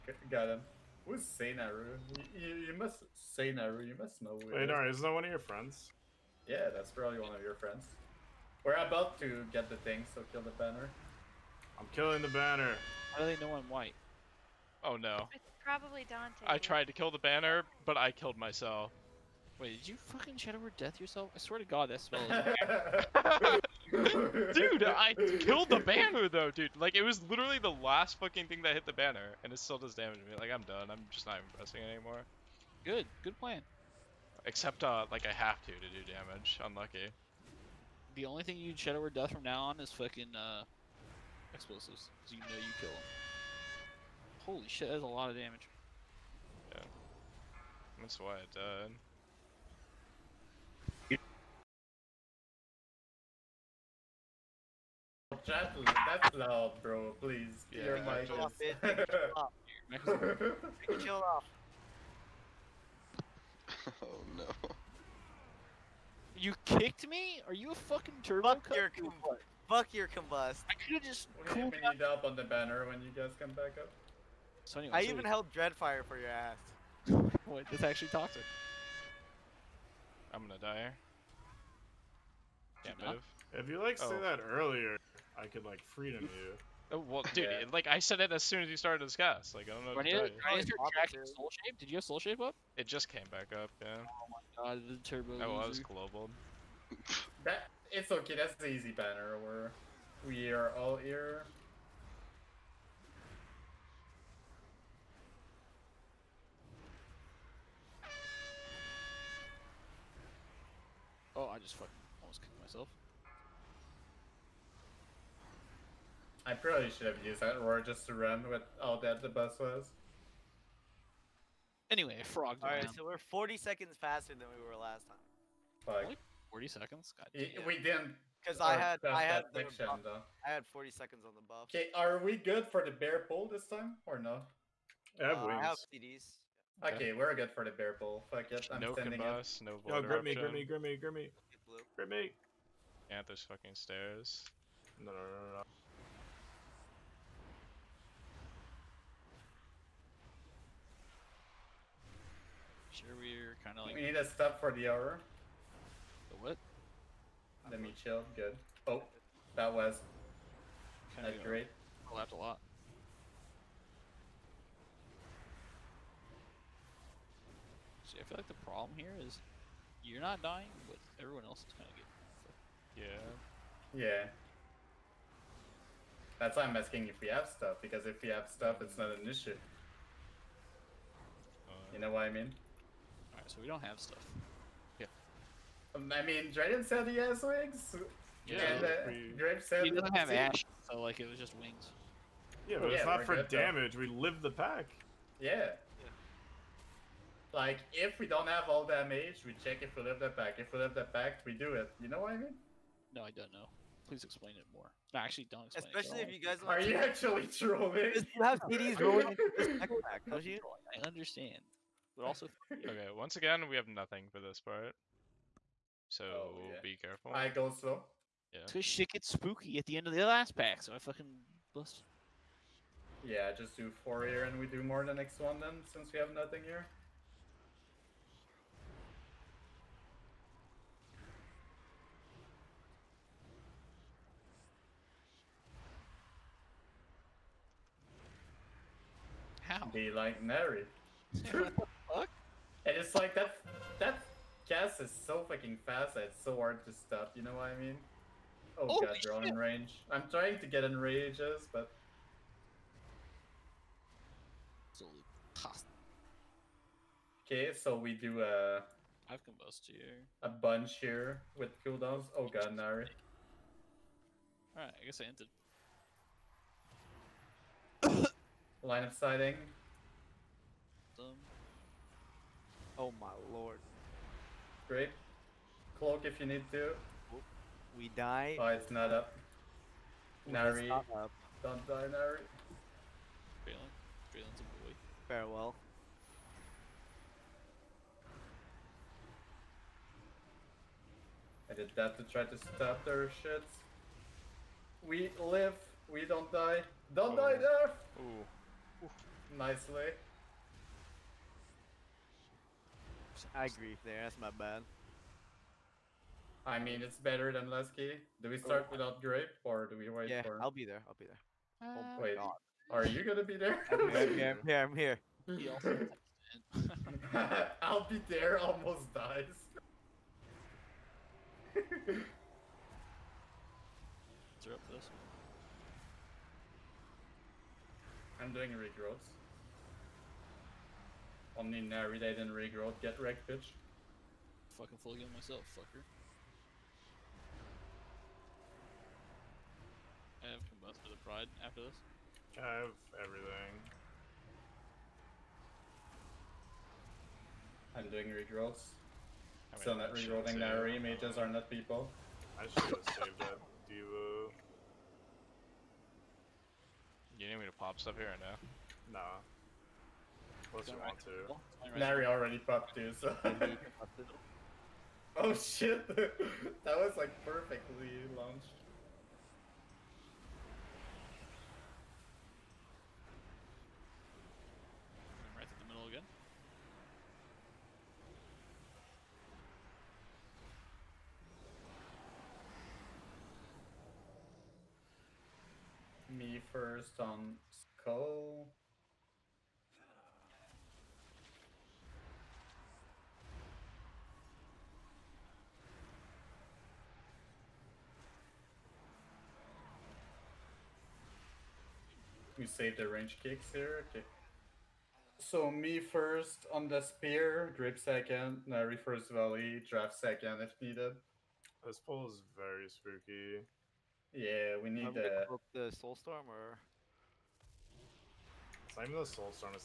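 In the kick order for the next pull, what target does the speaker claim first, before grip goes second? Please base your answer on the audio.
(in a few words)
the spear.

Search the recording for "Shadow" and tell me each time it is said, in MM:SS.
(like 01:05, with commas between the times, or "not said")
00:20, 00:38.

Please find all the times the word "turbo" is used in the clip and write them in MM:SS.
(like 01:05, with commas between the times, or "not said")
01:08, 01:35.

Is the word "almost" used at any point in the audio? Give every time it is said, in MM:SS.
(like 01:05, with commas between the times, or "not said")
01:52, 05:18.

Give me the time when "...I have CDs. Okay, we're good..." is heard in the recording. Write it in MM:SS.
02:15.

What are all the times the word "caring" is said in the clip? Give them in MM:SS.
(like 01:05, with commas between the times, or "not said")
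not said.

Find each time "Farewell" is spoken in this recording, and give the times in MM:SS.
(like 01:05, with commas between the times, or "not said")
04:45.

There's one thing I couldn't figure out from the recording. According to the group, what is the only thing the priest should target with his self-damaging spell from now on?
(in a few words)
explosives.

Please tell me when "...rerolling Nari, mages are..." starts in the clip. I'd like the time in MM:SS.
05:50.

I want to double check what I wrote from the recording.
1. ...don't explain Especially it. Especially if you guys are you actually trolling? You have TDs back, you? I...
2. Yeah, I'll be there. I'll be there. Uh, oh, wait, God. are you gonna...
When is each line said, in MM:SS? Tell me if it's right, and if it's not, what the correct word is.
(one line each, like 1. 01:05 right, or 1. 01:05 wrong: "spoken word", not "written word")
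1. 03:25 right
2. 05:10 right.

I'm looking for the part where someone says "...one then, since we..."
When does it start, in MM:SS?
03:45.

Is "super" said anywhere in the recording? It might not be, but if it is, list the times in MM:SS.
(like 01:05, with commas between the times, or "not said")
not said.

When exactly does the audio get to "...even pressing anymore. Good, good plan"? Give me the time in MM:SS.
00:31.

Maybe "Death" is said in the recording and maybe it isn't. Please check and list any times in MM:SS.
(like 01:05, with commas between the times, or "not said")
00:20, 00:39.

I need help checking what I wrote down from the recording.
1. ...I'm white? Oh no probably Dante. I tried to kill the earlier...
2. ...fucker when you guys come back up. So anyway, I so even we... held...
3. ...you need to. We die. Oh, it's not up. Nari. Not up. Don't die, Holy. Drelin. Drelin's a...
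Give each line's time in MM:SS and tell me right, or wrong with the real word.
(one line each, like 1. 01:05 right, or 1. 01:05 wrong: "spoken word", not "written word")
1. 00:13 wrong: "banner", not "earlier"
2. 01:12 wrong: "banner", not "fucker"
3. 04:36 wrong: "Nari", not "Holy".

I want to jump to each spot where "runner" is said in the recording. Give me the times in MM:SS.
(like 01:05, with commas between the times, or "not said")
not said.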